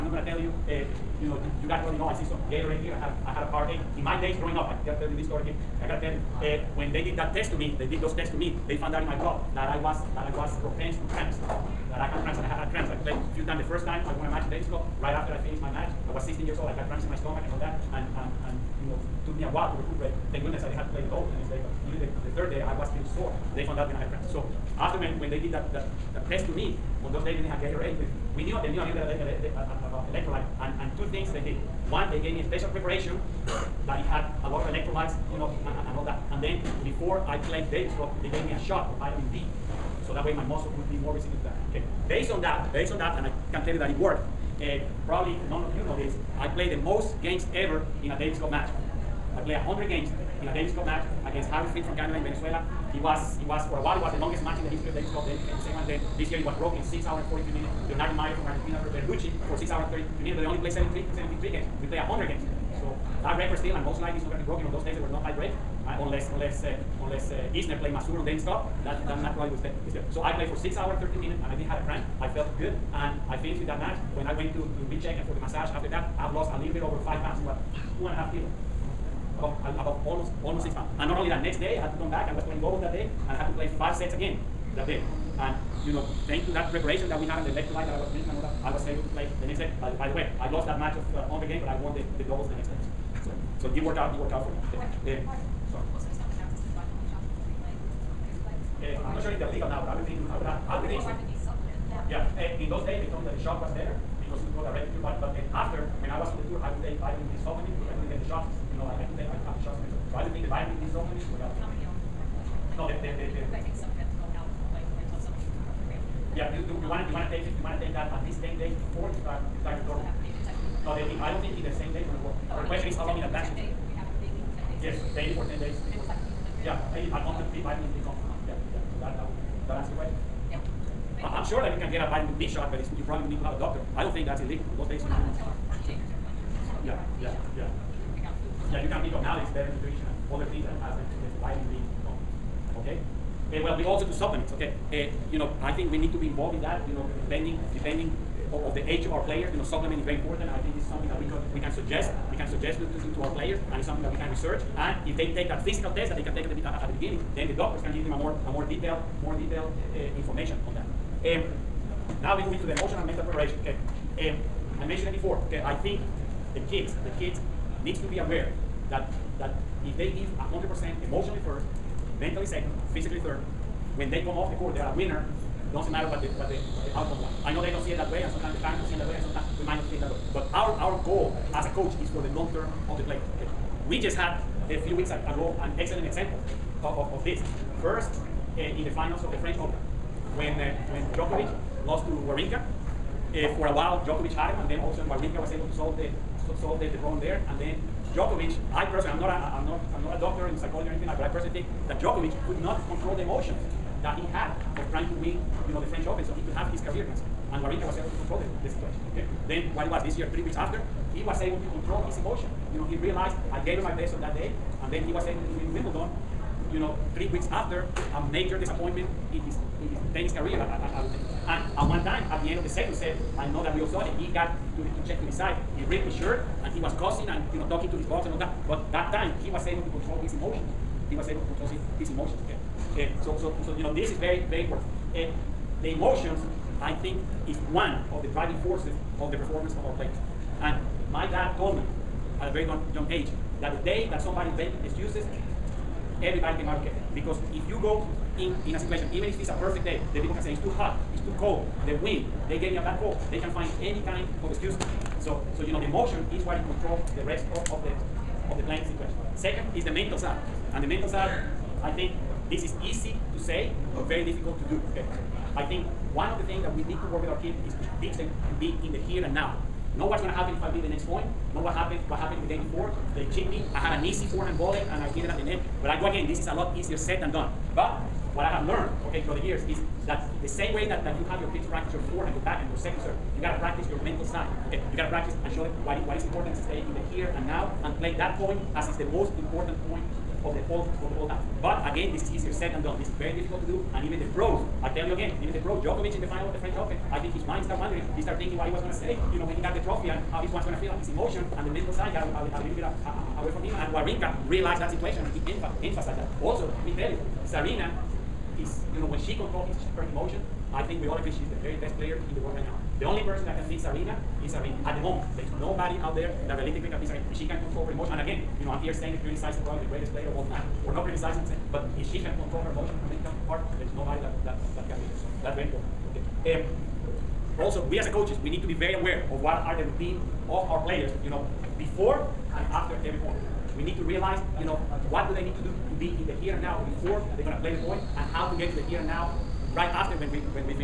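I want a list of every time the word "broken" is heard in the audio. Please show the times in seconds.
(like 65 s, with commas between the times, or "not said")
56 s, 64 s.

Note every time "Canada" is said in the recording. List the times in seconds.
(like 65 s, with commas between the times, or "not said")
51 s.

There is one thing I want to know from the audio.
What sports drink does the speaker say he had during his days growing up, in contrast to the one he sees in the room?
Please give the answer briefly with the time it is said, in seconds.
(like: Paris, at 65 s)
Powerade, at 3 s.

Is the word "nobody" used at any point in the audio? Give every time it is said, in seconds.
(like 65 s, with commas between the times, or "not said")
315 s, 323 s.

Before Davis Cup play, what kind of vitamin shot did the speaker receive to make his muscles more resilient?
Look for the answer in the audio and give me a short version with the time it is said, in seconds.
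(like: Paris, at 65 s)
vitamin D, at 39 s.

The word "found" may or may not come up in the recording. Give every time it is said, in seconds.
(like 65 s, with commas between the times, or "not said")
8 s, 23 s.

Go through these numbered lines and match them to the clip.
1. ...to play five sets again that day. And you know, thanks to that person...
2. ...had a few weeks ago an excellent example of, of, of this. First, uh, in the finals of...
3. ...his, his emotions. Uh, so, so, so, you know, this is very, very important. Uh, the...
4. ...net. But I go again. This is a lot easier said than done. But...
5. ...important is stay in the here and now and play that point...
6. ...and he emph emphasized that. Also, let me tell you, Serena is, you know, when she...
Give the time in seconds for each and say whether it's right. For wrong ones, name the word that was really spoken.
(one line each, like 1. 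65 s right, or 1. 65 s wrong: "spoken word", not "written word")
1. 83 s wrong: "preparation", not "person"
2. 184 s right
3. 231 s right
4. 275 s right
5. 286 s right
6. 305 s right.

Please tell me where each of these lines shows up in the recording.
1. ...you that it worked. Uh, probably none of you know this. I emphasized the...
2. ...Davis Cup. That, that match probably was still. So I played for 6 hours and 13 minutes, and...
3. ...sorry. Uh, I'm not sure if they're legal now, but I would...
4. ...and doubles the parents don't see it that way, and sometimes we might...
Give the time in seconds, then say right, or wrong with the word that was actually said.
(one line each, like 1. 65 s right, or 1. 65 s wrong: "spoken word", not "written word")
1. 43 s wrong: "played", not "emphasized"
2. 68 s right
3. 95 s right
4. 178 s wrong: "sometimes", not "doubles".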